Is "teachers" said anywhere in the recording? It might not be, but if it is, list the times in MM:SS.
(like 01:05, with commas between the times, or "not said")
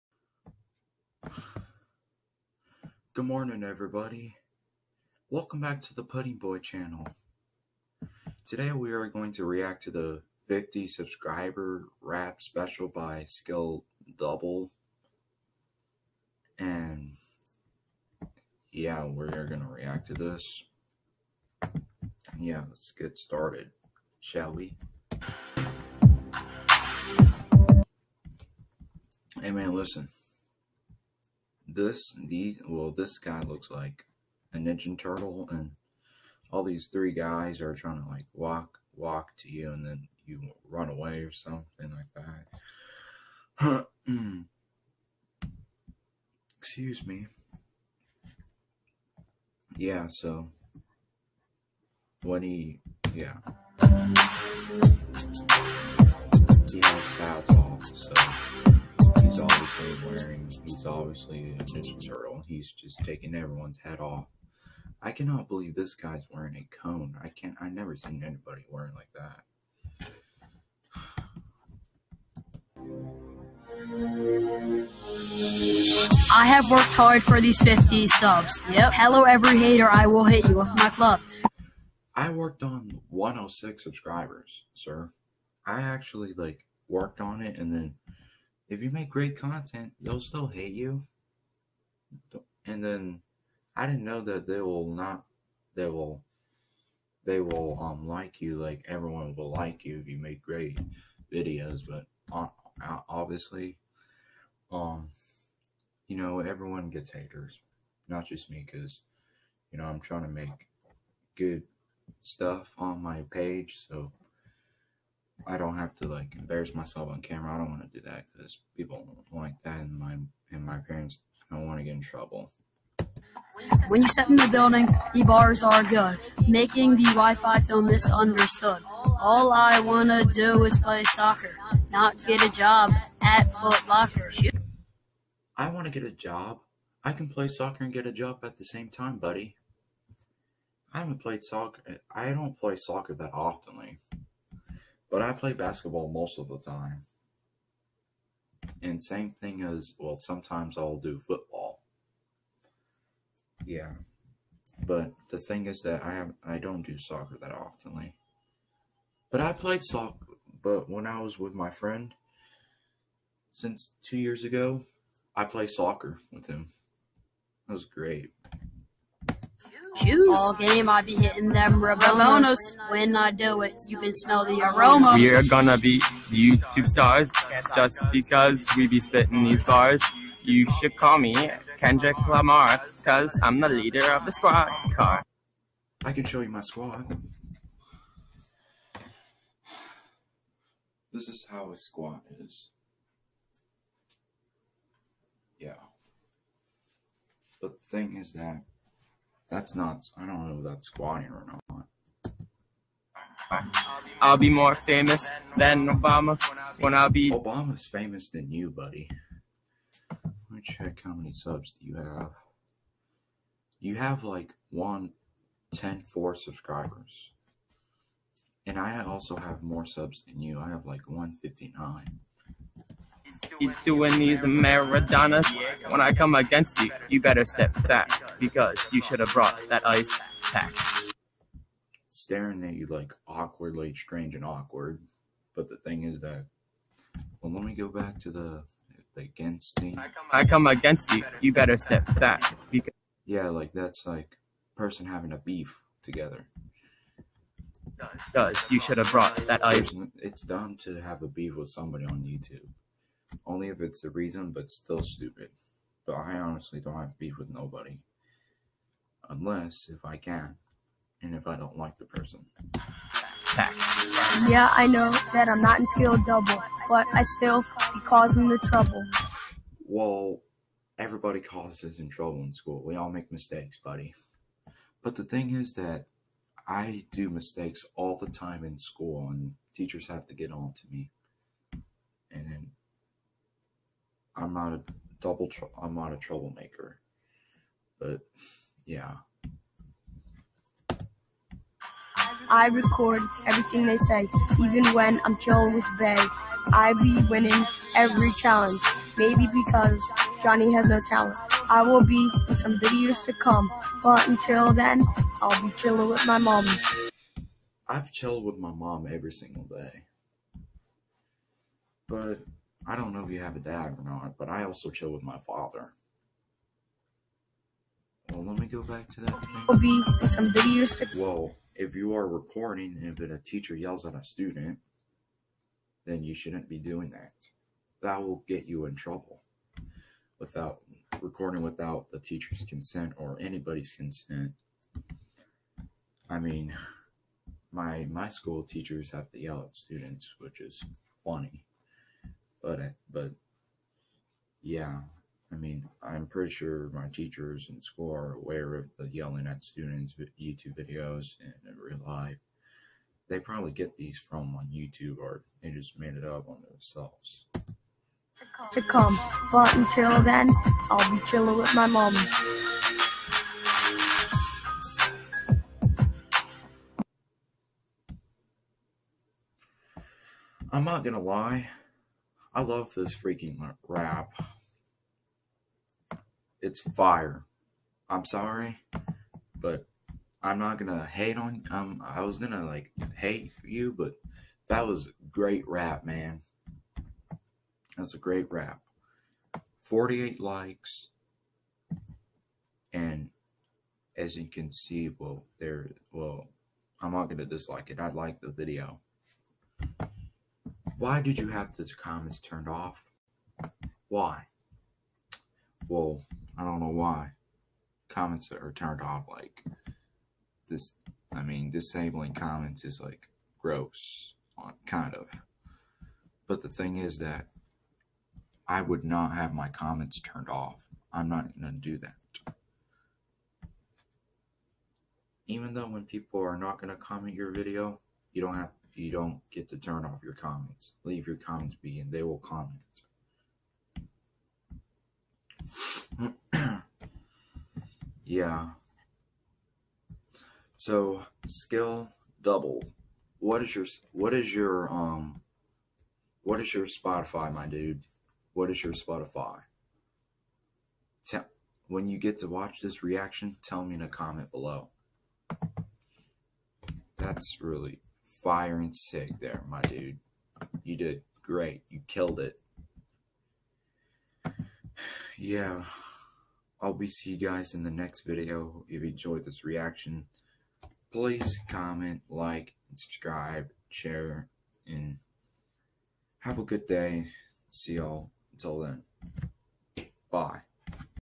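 04:39, 05:23, 05:32, 05:38, 05:47.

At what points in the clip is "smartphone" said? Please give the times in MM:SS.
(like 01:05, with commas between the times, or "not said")
not said.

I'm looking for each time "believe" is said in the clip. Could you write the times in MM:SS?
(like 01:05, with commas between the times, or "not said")
01:05.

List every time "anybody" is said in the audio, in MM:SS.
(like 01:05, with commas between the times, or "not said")
01:08, 05:33.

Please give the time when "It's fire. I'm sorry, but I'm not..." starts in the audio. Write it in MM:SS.
06:16.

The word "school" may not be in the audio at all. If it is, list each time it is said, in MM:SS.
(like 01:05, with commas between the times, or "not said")
04:32, 04:38, 05:38, 05:47.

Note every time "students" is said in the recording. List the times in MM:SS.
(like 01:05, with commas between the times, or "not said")
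05:24, 05:39, 05:49.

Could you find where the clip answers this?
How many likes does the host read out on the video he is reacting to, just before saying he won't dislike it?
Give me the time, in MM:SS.
06:29.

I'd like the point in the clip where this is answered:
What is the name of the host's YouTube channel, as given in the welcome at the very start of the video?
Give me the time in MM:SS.
00:06.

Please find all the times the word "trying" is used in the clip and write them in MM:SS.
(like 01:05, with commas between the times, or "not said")
00:37, 01:49.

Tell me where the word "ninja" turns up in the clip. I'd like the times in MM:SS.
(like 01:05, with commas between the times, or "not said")
00:34, 01:01.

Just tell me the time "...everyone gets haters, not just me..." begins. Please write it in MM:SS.
01:46.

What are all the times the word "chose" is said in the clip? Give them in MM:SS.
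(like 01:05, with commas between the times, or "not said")
not said.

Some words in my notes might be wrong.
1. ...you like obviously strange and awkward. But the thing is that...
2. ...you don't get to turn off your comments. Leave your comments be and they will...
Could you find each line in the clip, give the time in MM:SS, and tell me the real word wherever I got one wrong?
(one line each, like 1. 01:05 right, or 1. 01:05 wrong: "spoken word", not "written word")
1. 03:52 wrong: "awkwardly", not "obviously"
2. 07:08 right.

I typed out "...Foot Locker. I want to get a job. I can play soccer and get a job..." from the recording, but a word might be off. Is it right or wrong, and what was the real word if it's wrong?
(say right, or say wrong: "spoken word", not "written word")
right.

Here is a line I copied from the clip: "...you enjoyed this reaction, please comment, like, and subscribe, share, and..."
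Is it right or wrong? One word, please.
right.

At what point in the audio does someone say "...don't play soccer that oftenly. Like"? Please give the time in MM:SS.
02:22.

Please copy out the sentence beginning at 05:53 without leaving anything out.
They probably get these from on YouTube or they just made it up on themselves.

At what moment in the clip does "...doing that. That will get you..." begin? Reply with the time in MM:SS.
05:26.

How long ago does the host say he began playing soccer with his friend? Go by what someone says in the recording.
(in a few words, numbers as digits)
Two years ago.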